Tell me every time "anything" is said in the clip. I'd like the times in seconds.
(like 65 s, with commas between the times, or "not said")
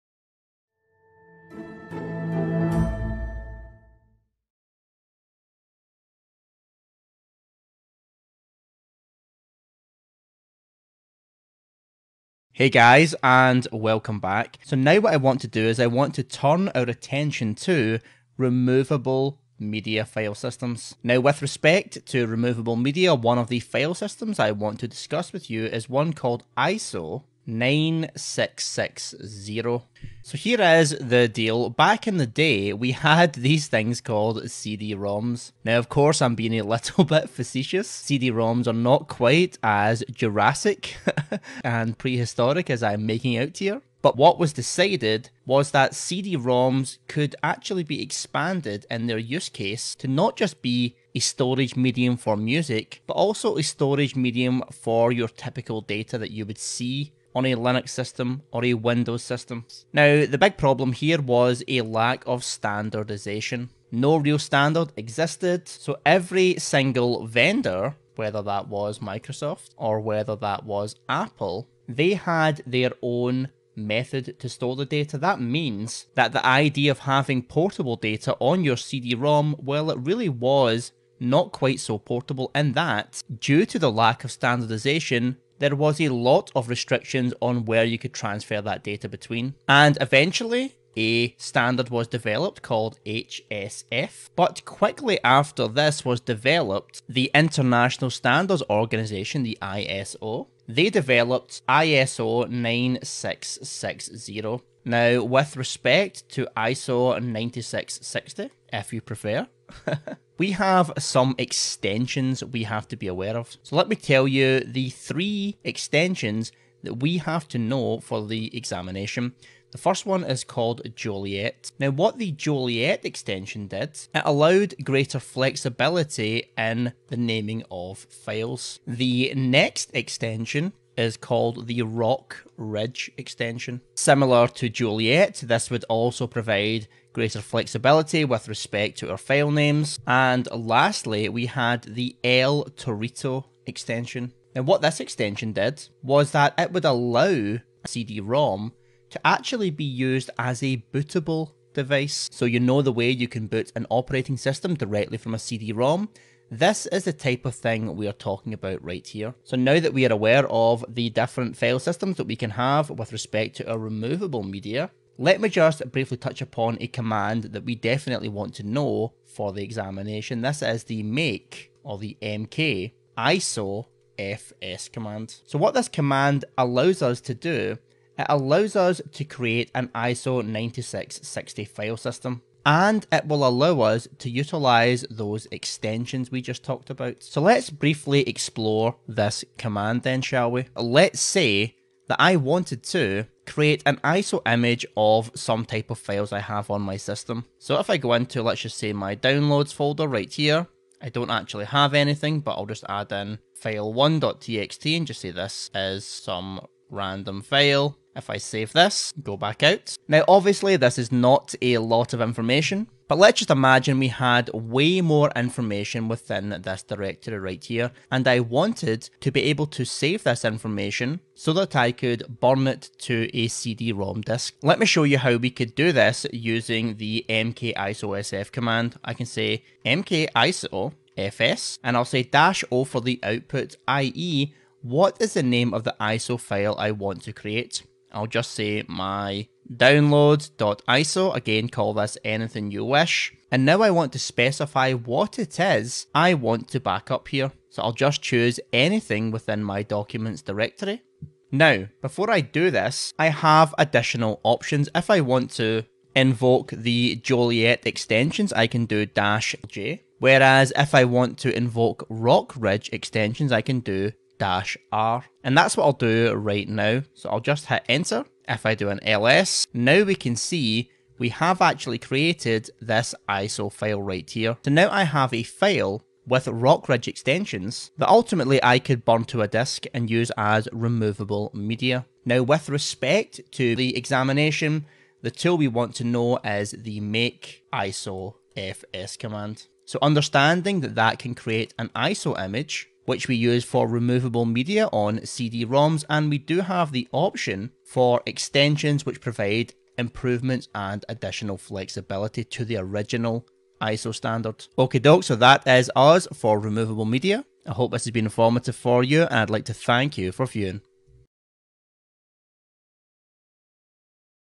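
201 s, 242 s, 248 s.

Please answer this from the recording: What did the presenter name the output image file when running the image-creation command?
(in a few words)
my download.iso.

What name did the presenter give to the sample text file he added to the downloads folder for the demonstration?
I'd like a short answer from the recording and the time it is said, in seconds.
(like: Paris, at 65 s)
file1.txt, at 203 s.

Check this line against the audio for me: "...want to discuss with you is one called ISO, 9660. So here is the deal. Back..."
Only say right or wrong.
right.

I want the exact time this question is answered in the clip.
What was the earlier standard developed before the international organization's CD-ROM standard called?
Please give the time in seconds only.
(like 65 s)
93 s.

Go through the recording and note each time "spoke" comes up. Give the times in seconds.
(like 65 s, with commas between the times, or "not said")
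not said.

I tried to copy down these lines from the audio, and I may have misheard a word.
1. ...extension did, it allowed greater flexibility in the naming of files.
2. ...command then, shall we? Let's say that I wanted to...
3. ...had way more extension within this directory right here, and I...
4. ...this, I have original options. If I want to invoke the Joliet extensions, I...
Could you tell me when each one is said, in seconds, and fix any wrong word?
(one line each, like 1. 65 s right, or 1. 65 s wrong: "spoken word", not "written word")
1. 123 s right
2. 189 s right
3. 214 s wrong: "information", not "extension"
4. 252 s wrong: "additional", not "original".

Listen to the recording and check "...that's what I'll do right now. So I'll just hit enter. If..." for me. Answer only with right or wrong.
right.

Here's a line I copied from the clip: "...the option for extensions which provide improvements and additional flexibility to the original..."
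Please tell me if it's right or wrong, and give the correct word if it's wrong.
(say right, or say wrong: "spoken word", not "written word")
right.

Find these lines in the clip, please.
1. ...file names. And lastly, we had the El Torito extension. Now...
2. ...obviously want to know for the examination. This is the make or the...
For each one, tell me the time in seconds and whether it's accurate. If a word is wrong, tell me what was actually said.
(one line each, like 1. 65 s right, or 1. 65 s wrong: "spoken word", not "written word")
1. 139 s right
2. 167 s wrong: "definitely", not "obviously".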